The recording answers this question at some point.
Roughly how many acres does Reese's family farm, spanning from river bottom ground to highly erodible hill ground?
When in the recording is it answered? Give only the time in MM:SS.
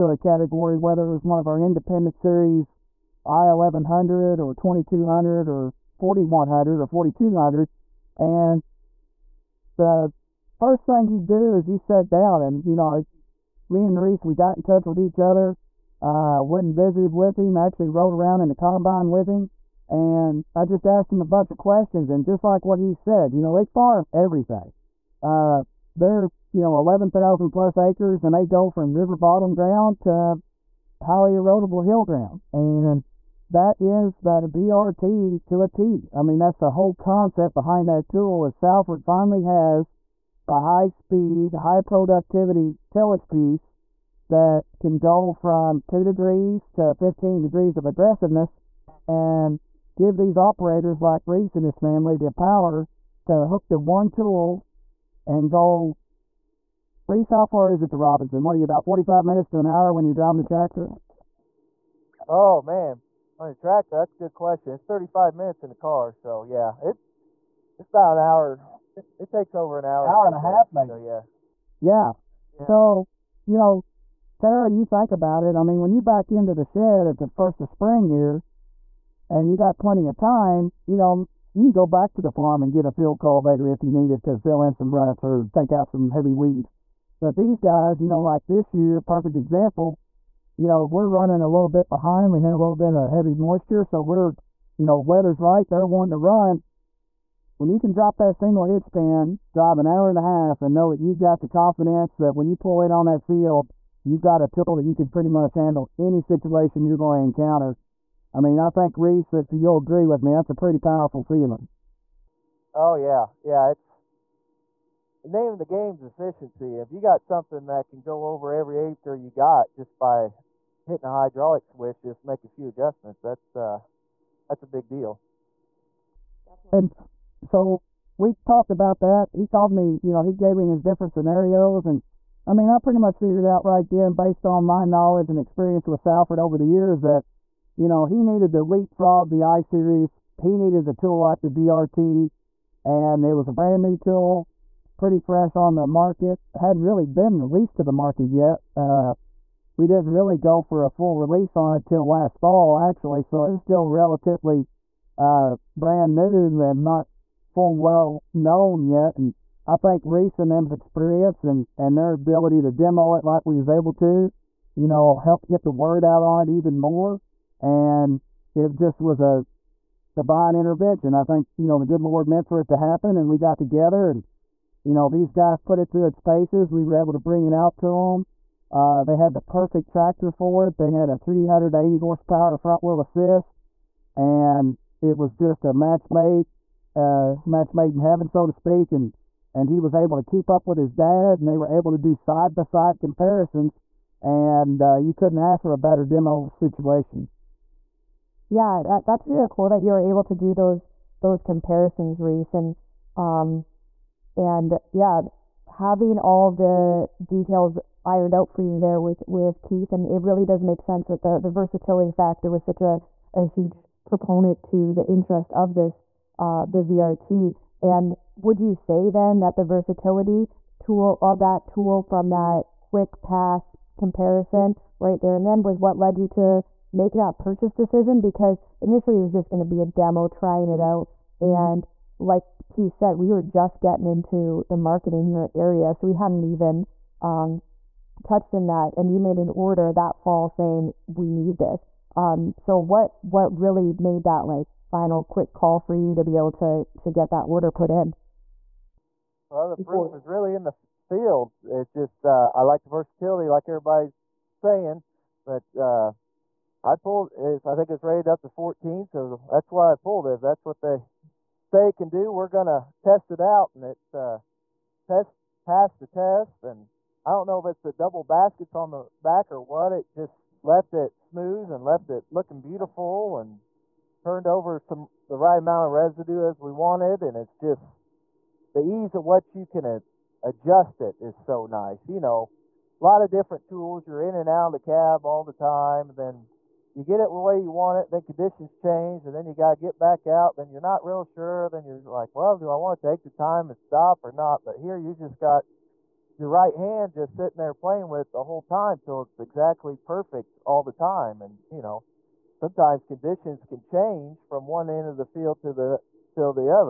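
00:26.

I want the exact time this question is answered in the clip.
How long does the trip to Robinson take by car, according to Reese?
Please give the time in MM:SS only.
01:04.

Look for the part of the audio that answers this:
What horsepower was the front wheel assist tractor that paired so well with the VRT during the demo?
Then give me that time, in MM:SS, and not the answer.
03:01.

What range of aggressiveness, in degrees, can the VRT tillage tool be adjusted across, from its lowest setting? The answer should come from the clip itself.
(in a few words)
2 to 15 degrees.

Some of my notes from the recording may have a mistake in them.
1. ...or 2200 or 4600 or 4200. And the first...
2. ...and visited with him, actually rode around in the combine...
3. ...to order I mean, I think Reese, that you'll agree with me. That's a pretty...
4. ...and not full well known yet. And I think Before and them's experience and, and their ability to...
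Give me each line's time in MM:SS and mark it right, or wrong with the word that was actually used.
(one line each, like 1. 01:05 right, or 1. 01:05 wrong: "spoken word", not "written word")
1. 00:04 wrong: "4100", not "4600"
2. 00:16 right
3. 01:47 wrong: "encounter", not "order"
4. 02:36 wrong: "Reese", not "Before".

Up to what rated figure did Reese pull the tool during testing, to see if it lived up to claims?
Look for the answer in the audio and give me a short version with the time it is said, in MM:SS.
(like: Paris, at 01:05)
14, at 04:18.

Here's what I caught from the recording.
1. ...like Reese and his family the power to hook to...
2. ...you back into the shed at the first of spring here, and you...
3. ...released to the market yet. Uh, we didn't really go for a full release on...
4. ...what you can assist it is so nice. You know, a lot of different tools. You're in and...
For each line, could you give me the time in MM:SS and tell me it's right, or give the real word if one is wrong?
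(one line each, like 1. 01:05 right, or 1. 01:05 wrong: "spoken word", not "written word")
1. 00:51 right
2. 01:15 right
3. 02:27 right
4. 04:39 wrong: "adjust", not "assist".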